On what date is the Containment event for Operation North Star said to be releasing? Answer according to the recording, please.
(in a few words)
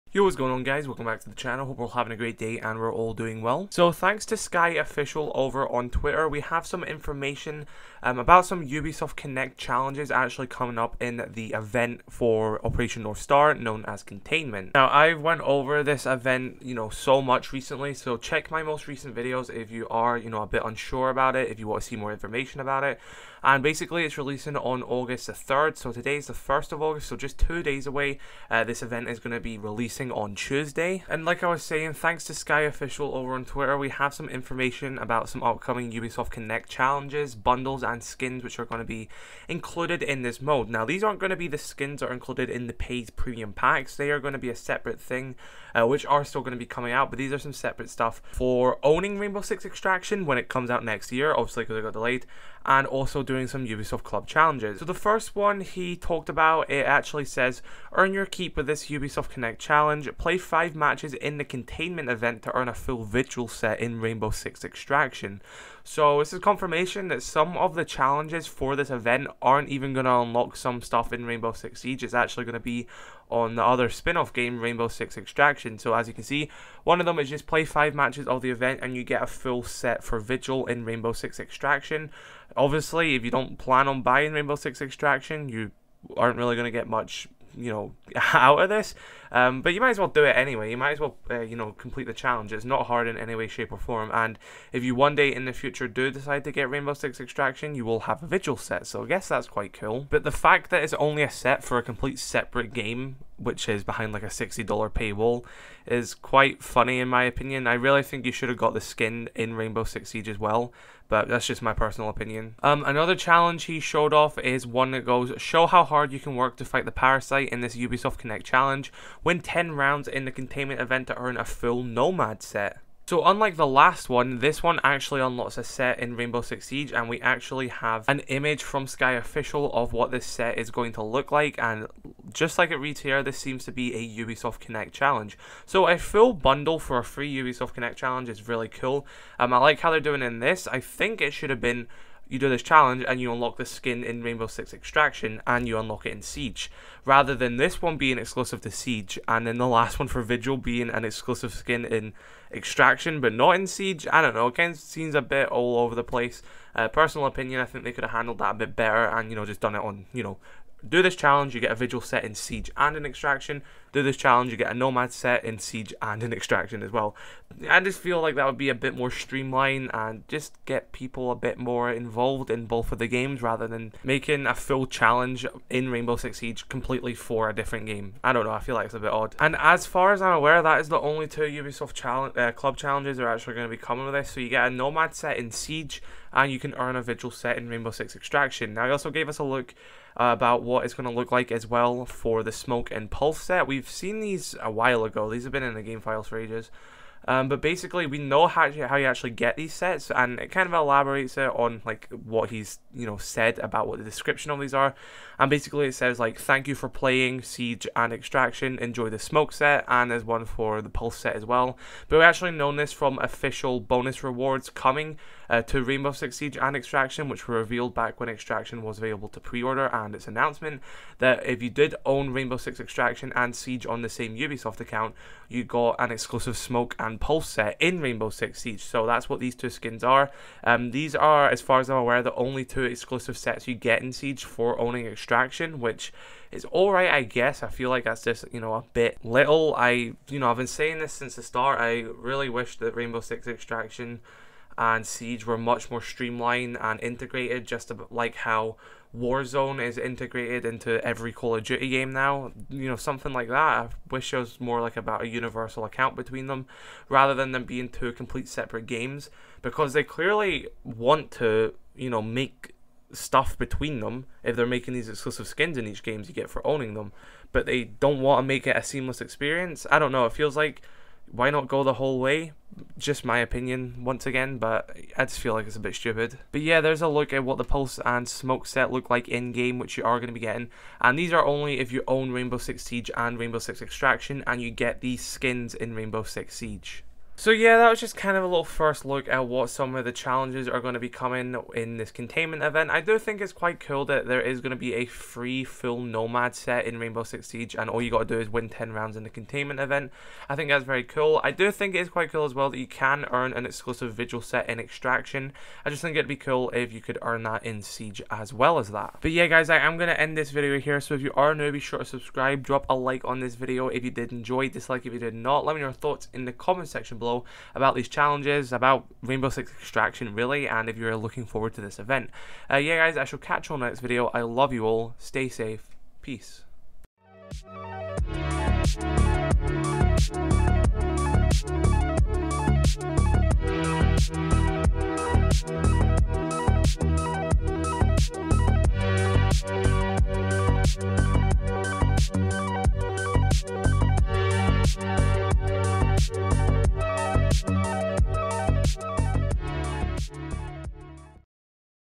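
August 3rd.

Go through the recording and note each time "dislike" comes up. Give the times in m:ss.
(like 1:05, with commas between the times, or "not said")
5:14.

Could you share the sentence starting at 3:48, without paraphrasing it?
So that's what these two skins are.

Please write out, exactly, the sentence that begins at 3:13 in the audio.
We've we've seen these a while ago.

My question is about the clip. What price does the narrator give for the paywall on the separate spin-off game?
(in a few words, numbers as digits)
$60.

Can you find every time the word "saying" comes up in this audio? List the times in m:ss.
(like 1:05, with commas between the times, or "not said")
0:31, 4:00.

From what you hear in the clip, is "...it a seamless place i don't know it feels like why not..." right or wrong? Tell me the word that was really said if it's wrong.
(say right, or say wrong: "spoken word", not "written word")
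wrong: "experience", not "place".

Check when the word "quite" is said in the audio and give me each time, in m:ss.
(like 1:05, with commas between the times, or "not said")
1:39, 1:46, 4:53, 5:02.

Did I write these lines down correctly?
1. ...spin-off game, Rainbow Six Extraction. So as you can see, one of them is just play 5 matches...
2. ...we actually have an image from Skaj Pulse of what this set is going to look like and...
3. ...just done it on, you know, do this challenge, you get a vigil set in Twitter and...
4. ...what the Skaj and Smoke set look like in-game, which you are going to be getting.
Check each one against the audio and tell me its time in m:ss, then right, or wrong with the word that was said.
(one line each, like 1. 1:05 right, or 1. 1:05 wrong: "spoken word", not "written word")
1. 1:13 right
2. 2:07 wrong: "Official", not "Pulse"
3. 2:39 wrong: "Siege", not "Twitter"
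4. 4:37 wrong: "Pulse", not "Skaj".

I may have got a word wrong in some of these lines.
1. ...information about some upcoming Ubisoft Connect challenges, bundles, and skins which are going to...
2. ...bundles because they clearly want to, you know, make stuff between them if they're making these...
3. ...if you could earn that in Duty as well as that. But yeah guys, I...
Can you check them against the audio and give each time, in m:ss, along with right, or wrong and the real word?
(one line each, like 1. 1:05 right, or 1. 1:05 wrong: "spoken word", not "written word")
1. 0:34 right
2. 4:18 wrong: "games", not "bundles"
3. 5:06 wrong: "Siege", not "Duty".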